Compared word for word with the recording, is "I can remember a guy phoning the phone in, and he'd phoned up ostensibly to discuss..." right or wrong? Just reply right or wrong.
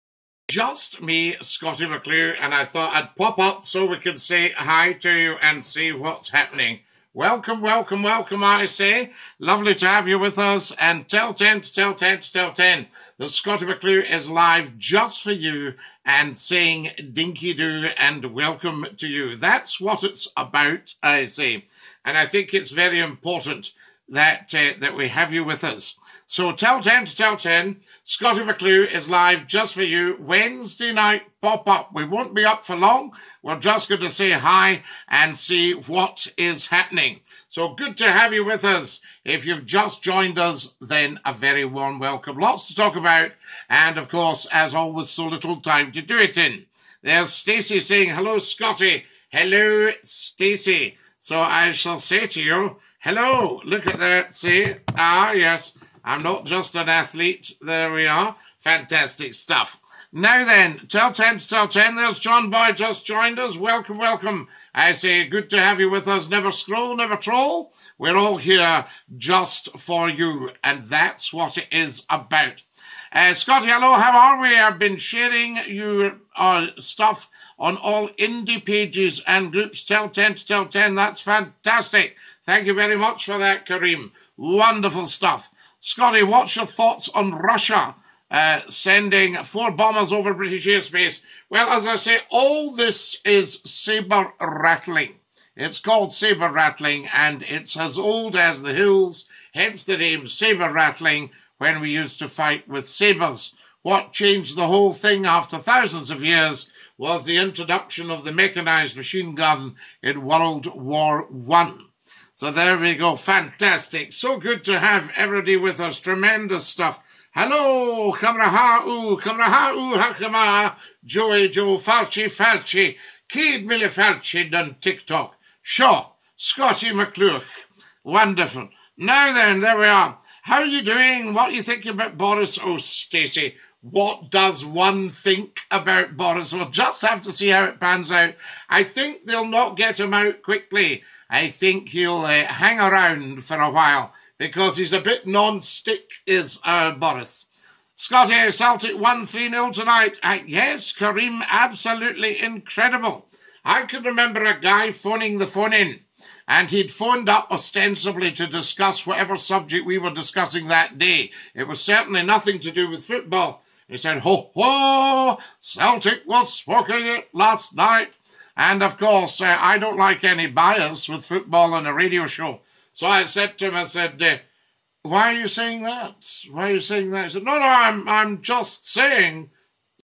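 right.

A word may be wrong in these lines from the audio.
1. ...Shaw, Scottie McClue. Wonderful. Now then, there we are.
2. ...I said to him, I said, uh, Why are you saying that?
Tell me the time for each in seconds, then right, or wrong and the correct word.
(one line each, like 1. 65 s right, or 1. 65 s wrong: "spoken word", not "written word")
1. 125 s right
2. 173 s right.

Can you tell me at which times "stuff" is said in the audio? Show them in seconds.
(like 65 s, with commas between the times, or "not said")
59 s, 76 s, 85 s, 116 s.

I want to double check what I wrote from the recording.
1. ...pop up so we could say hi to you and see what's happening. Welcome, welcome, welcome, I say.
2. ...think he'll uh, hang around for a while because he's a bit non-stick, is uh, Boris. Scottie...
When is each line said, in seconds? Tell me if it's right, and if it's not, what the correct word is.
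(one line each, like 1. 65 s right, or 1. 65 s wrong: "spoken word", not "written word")
1. 3 s right
2. 141 s right.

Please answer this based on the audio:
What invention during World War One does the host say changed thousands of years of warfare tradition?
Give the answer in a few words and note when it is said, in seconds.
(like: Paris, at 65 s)
mechanized machine gun, at 108 s.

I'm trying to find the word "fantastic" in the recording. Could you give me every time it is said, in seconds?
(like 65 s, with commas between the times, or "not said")
58 s, 81 s, 113 s.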